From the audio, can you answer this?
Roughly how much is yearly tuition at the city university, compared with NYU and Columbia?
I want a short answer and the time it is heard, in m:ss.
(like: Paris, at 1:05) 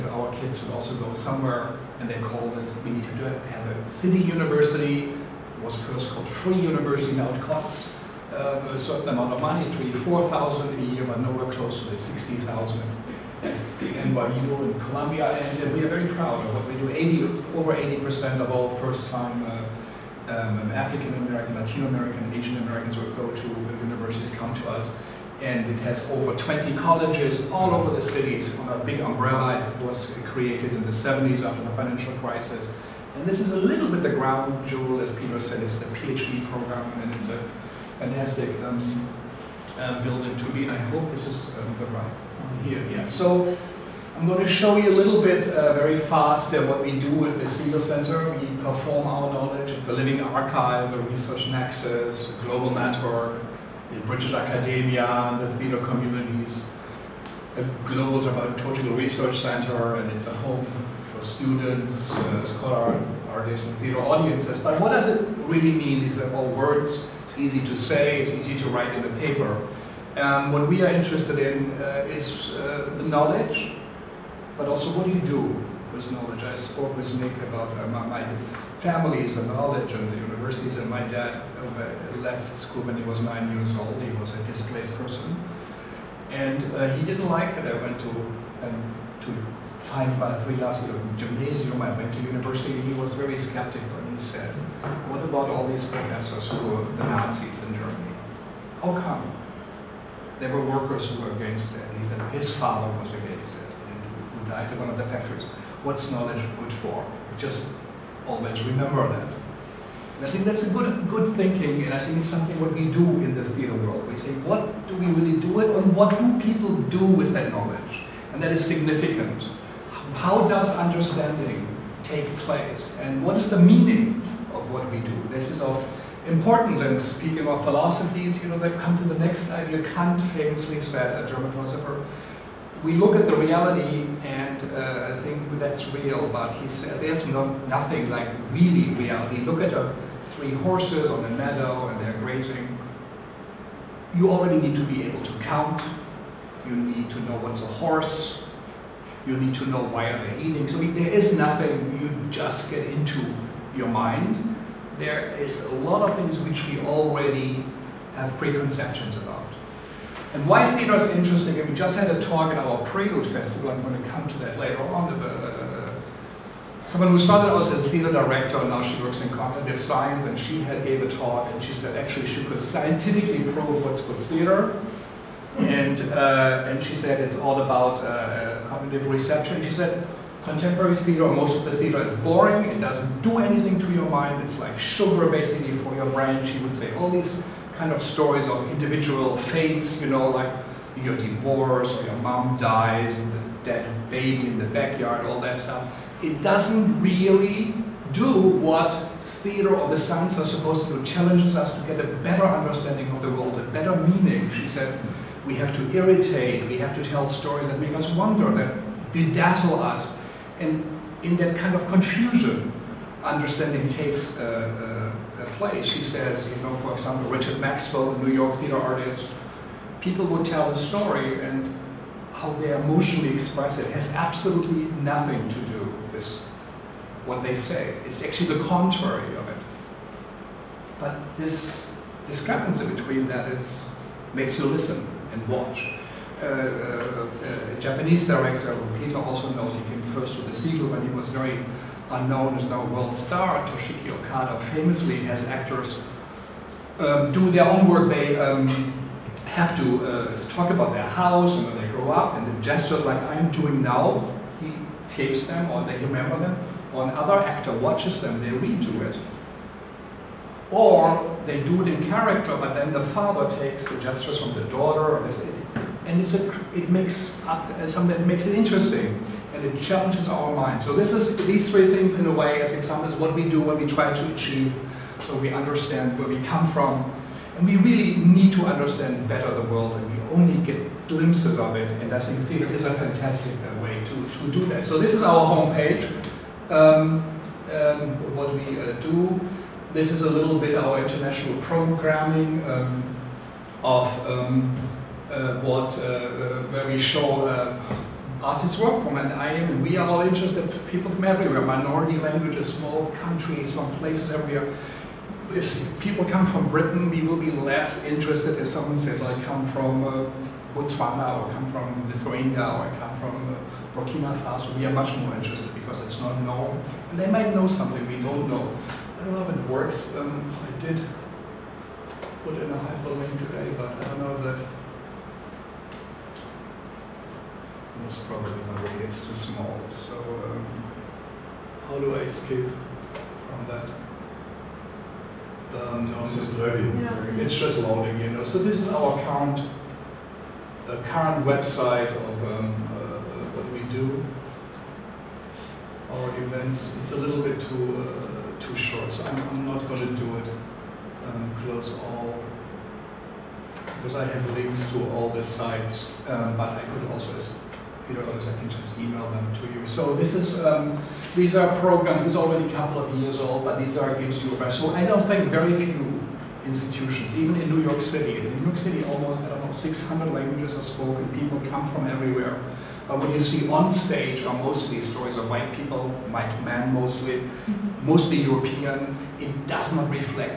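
3,000-4,000, at 0:09.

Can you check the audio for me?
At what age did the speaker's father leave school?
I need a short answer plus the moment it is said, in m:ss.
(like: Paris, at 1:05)
9, at 1:23.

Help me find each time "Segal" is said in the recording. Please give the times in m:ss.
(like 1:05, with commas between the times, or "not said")
0:47, 4:00.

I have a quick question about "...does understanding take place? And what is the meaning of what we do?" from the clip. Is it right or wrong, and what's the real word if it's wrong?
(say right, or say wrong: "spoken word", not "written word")
right.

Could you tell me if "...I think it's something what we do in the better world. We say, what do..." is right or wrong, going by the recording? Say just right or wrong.
wrong.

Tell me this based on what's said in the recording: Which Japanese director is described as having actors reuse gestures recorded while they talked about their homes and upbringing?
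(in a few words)
Toshiki Okada.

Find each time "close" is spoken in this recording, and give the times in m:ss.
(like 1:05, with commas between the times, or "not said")
0:11, 5:51.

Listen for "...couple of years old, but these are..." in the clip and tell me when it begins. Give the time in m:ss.
6:02.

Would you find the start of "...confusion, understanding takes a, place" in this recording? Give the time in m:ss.
3:31.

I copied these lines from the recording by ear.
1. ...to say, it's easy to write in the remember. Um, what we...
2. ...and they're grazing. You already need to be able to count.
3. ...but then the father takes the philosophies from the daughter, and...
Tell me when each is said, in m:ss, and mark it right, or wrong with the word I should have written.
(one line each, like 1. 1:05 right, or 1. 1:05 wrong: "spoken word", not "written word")
1. 1:07 wrong: "paper", not "remember"
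2. 2:21 right
3. 4:22 wrong: "gestures", not "philosophies".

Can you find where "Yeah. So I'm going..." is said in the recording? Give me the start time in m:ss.
0:42.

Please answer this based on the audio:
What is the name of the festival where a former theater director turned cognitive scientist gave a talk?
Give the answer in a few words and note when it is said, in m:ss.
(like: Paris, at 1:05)
Prelude Festival, at 2:42.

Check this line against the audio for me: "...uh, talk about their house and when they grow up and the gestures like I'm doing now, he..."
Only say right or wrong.
right.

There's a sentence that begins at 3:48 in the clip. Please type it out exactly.
It's actually the contrary of it.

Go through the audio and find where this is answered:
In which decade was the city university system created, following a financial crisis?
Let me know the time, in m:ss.
0:30.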